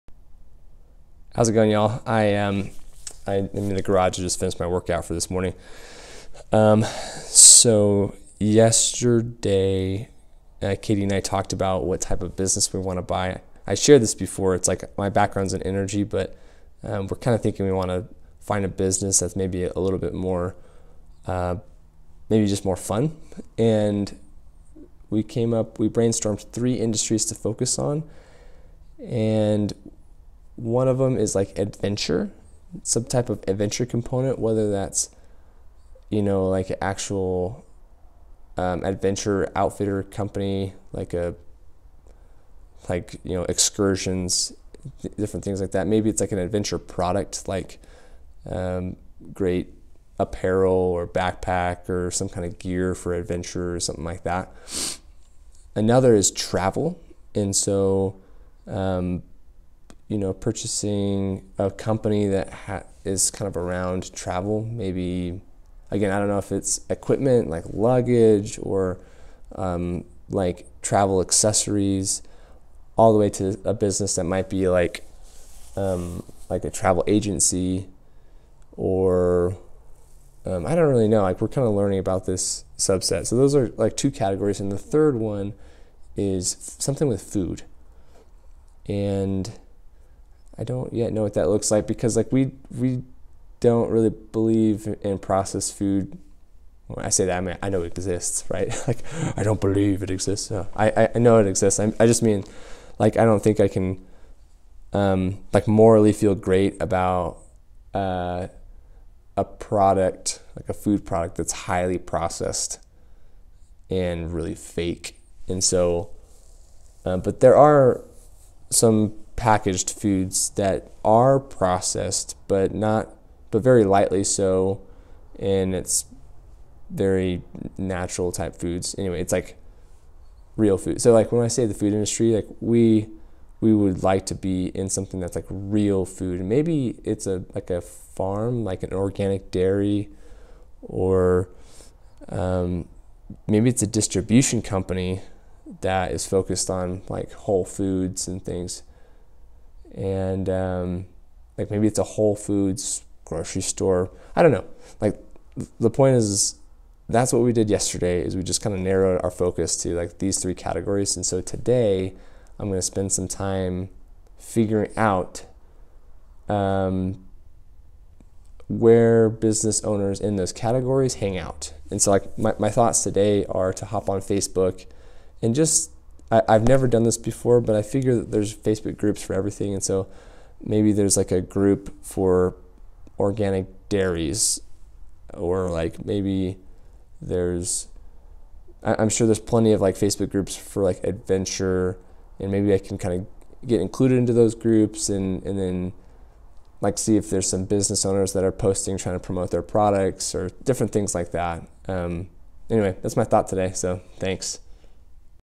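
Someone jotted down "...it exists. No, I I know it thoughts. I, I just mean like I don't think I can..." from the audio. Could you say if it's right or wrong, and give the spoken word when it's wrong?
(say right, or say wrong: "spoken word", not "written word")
wrong: "exists", not "thoughts".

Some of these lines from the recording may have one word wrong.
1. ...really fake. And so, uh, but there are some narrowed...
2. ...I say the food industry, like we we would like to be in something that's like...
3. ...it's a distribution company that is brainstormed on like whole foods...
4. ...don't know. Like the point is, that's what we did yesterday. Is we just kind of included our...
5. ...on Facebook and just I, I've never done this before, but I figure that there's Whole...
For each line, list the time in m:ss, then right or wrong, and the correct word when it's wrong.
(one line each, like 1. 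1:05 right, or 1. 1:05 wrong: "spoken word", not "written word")
1. 1:54 wrong: "packaged", not "narrowed"
2. 2:11 right
3. 2:23 wrong: "focused", not "brainstormed"
4. 2:34 wrong: "narrowed", not "included"
5. 2:54 wrong: "Facebook", not "Whole".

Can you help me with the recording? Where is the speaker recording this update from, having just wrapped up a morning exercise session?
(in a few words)
The garage.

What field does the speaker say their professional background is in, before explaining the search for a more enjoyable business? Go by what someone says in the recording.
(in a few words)
Energy.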